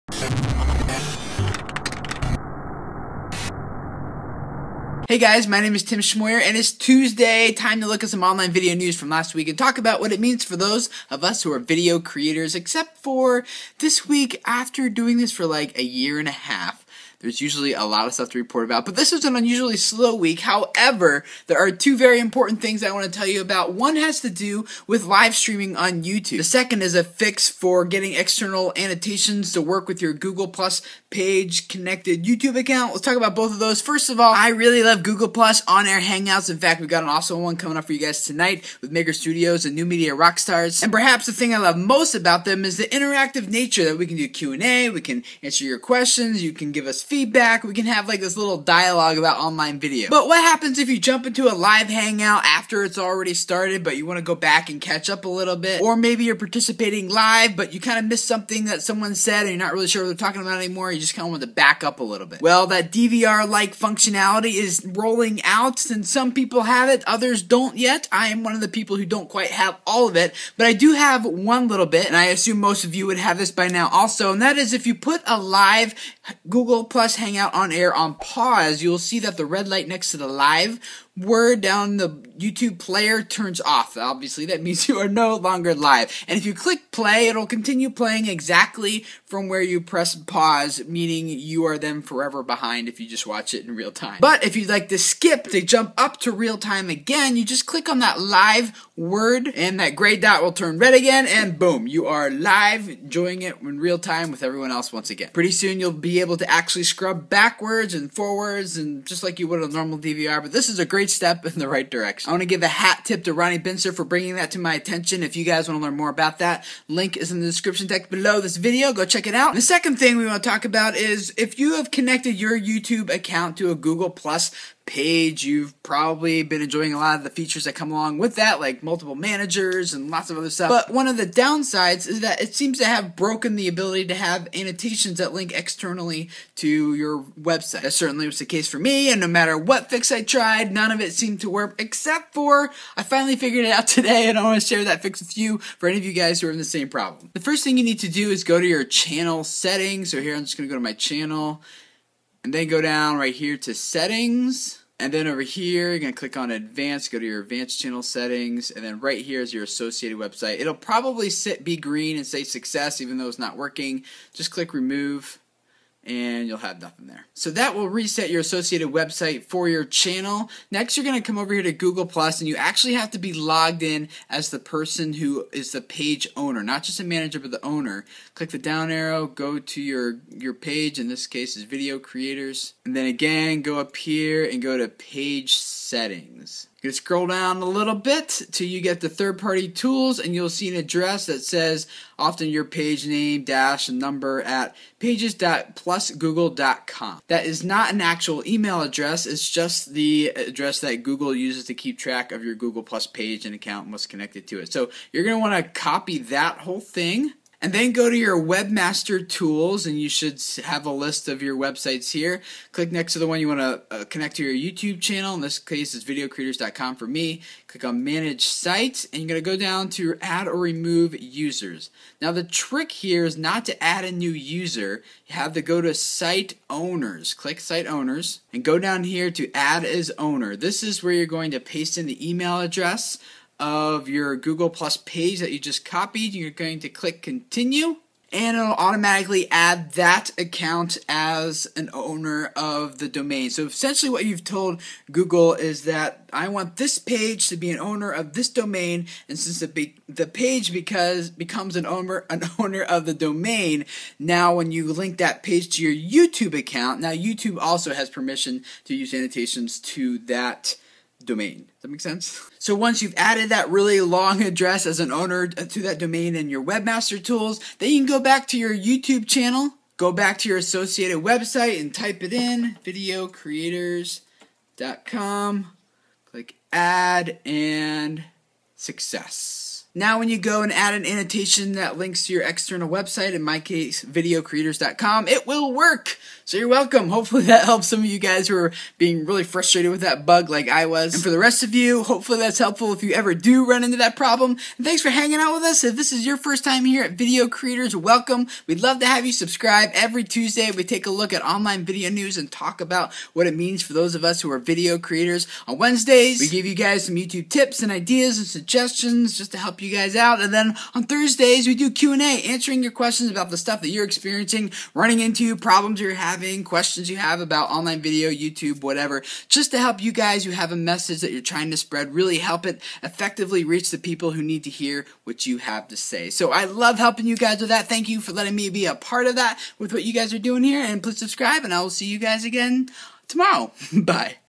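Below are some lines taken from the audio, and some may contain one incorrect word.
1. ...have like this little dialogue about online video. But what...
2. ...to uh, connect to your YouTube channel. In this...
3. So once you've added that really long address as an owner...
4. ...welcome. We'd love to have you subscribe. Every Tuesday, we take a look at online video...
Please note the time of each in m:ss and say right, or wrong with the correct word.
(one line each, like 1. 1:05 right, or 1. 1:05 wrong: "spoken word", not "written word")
1. 0:47 right
2. 3:33 right
3. 4:22 right
4. 4:57 right.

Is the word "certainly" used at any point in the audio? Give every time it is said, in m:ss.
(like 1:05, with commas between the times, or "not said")
2:17.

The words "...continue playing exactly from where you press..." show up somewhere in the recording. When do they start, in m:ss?
1:27.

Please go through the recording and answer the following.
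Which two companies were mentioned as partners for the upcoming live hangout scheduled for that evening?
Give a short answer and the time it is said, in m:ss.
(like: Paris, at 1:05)
Maker Studios and New Media Rockstars, at 0:38.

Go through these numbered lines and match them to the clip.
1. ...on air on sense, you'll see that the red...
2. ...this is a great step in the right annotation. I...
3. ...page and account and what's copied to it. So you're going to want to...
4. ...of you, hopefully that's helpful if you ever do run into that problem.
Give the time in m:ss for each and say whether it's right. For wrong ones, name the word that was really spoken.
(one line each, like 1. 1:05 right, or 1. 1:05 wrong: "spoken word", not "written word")
1. 1:17 wrong: "pause", not "sense"
2. 1:50 wrong: "direction", not "annotation"
3. 3:23 wrong: "connected", not "copied"
4. 4:51 right.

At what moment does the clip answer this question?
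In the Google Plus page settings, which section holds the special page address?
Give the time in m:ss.
3:09.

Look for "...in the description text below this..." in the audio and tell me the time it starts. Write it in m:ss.
1:57.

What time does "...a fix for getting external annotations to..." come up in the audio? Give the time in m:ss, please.
0:26.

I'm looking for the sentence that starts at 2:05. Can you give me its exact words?
You've probably been enjoying a lot of the features that come along with that, like multiple managers and lots of other stuff.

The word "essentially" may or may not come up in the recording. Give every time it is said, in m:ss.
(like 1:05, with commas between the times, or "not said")
4:03.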